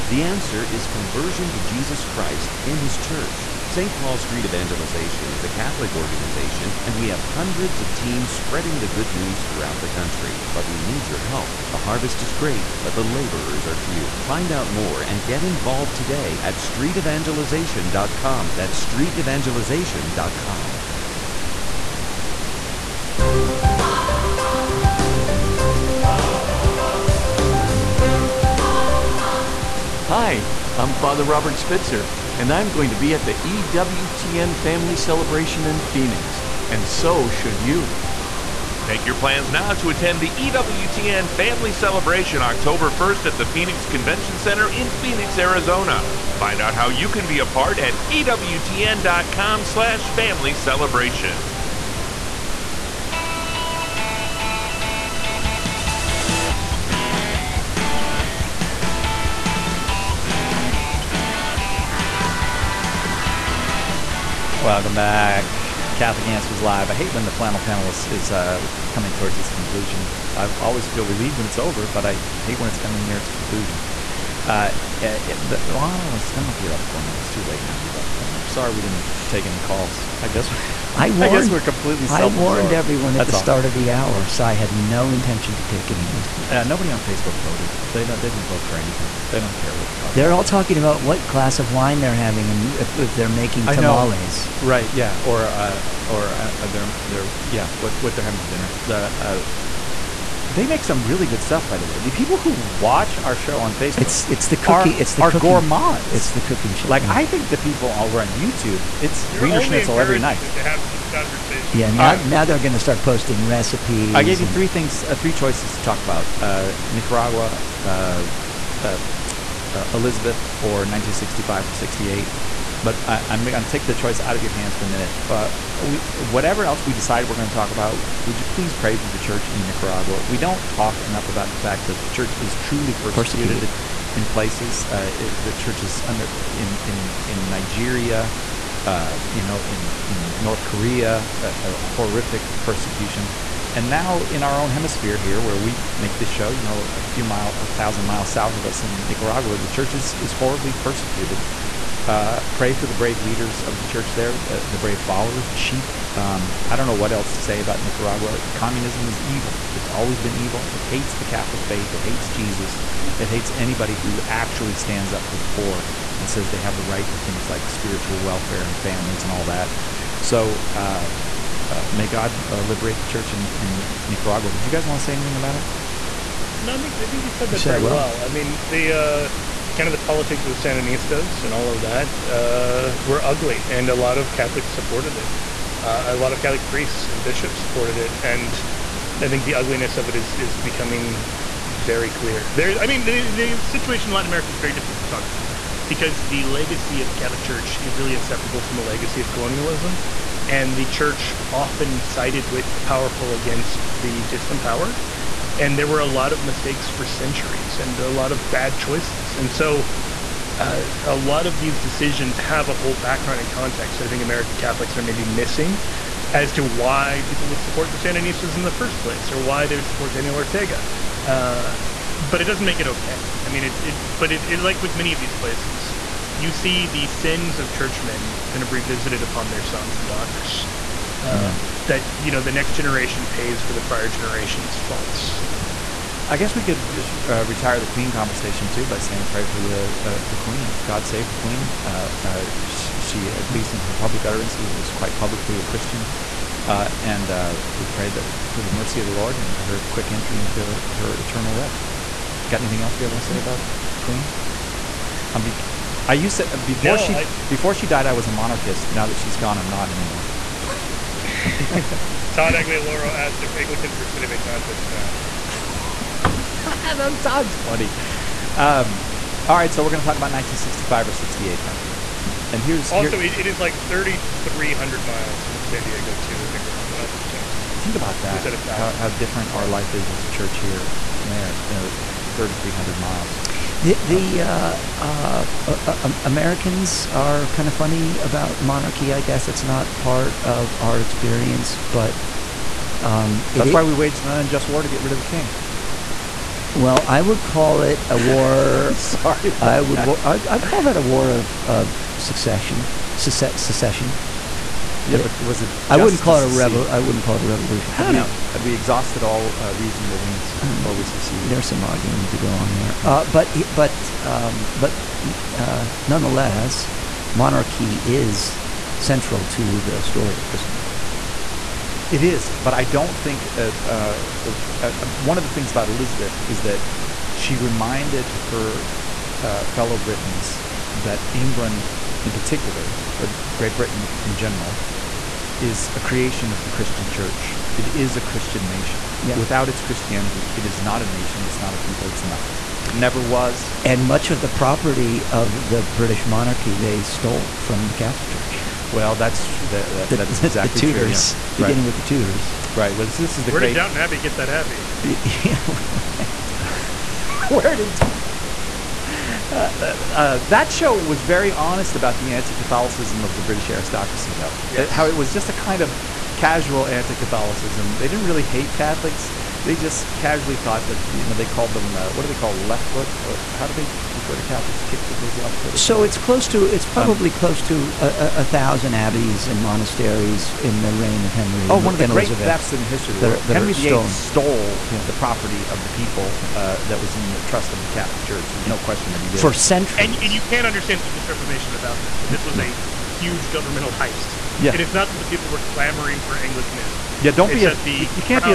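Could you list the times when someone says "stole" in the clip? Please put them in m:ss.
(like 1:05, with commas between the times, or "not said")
5:47, 6:24.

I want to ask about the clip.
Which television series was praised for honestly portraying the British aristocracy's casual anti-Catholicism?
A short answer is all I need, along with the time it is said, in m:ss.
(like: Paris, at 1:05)
Downton Abbey, at 5:53.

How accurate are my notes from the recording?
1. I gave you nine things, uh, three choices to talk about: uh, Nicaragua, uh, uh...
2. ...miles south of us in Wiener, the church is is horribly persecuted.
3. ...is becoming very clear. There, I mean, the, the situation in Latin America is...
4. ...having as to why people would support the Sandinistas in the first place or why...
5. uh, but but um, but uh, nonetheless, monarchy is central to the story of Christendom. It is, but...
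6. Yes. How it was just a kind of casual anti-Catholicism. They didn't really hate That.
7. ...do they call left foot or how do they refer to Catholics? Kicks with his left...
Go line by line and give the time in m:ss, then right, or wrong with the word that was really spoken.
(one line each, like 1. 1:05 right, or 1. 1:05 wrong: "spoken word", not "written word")
1. 1:54 wrong: "three", not "nine"
2. 2:28 wrong: "Nicaragua", not "Wiener"
3. 3:10 right
4. 3:35 wrong: "missing", not "having"
5. 5:13 right
6. 6:04 wrong: "Catholics", not "That"
7. 6:12 right.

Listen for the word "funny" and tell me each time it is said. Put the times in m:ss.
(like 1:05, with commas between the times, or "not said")
4:27, 4:47.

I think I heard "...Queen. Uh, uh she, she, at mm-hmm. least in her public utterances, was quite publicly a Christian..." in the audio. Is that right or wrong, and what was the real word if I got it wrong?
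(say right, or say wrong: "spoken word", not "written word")
right.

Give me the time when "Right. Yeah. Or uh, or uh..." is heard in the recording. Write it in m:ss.
1:34.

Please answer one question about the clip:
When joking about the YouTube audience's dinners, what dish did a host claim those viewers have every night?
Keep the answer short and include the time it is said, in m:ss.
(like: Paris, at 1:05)
Wiener Schnitzel, at 1:49.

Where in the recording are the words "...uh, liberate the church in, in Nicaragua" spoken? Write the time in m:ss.
2:52.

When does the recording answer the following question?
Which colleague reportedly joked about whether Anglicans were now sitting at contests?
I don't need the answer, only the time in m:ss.
4:22.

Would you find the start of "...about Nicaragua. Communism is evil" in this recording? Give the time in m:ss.
2:37.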